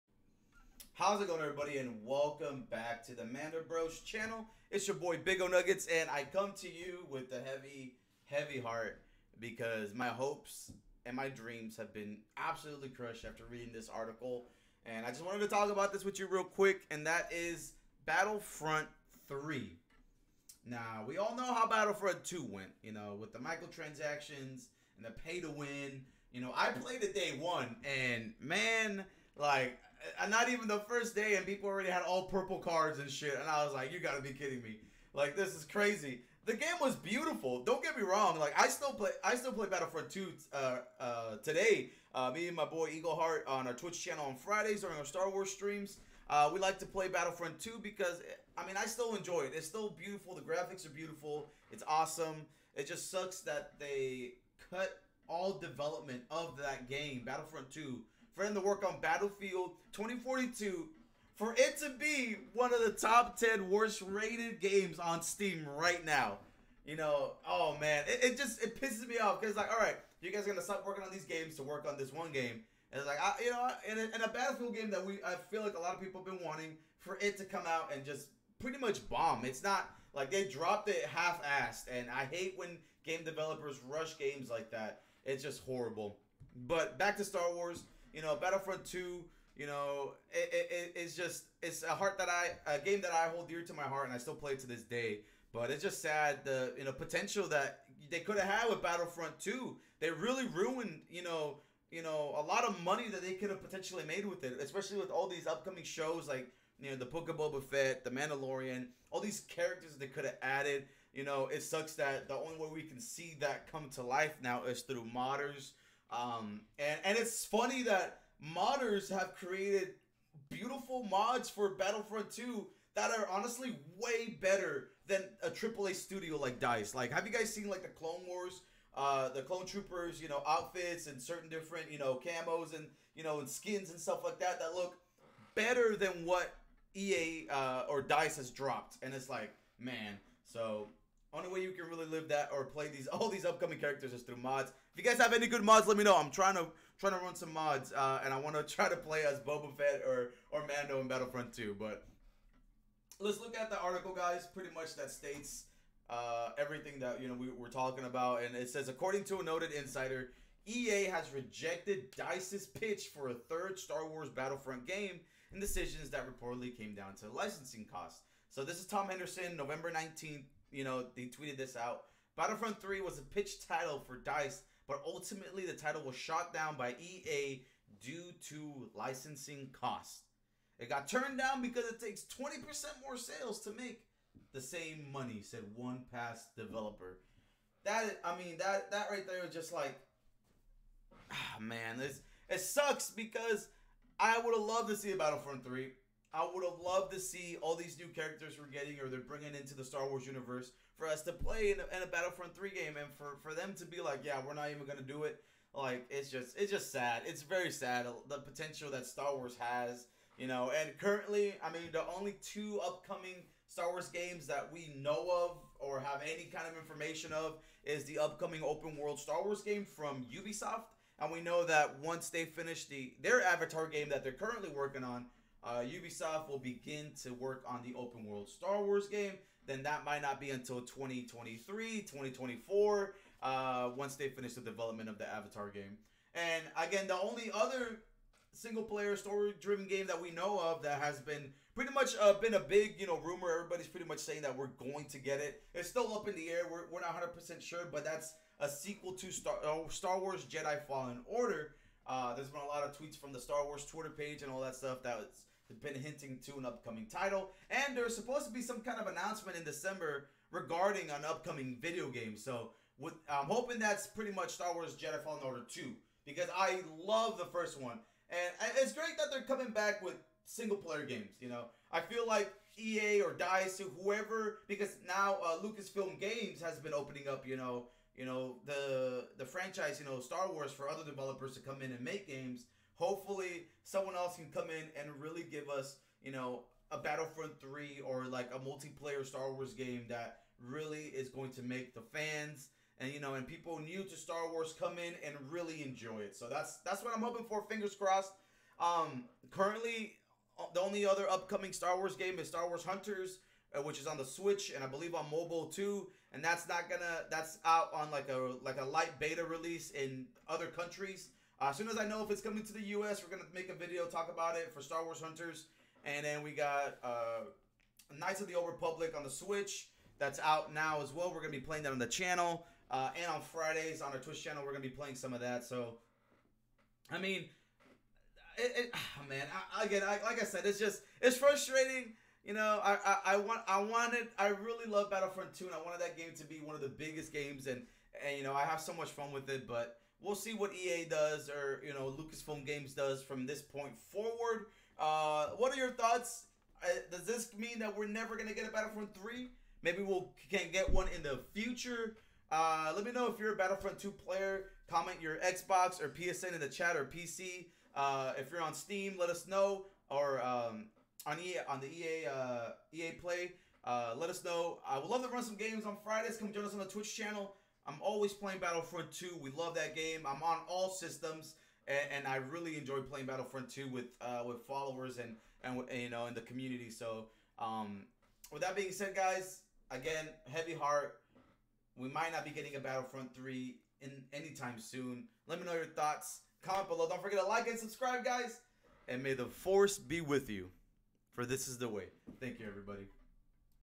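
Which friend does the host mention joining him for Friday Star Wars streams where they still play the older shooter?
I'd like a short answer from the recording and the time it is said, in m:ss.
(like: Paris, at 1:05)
Eagle Heart, at 0:42.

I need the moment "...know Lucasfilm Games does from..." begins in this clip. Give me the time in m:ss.
5:41.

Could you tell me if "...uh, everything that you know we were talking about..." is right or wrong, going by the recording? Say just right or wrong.
right.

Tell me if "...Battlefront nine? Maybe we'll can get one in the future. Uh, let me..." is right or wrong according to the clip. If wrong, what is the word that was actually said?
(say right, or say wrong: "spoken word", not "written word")
wrong: "three", not "nine".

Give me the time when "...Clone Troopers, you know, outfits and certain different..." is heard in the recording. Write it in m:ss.
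2:09.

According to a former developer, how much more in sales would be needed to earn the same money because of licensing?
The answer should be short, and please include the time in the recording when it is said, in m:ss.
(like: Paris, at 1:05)
20%, at 3:02.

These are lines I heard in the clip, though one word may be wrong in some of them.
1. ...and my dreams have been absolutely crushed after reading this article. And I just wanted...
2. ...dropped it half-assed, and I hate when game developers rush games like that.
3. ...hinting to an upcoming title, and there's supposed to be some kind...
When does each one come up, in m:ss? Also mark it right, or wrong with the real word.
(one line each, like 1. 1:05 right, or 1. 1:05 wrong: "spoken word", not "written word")
1. 0:11 right
2. 1:20 right
3. 4:16 right.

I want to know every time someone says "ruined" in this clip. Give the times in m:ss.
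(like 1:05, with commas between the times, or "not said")
1:40.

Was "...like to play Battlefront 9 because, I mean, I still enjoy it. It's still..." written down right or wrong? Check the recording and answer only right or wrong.
wrong.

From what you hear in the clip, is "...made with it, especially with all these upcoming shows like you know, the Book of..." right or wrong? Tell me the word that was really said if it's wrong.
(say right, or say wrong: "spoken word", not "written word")
right.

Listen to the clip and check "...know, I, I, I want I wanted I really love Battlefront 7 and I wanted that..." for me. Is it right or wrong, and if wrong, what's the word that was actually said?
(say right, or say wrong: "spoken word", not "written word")
wrong: "2", not "7".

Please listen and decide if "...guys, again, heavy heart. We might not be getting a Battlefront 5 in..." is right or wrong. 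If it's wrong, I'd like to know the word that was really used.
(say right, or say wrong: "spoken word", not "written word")
wrong: "3", not "5".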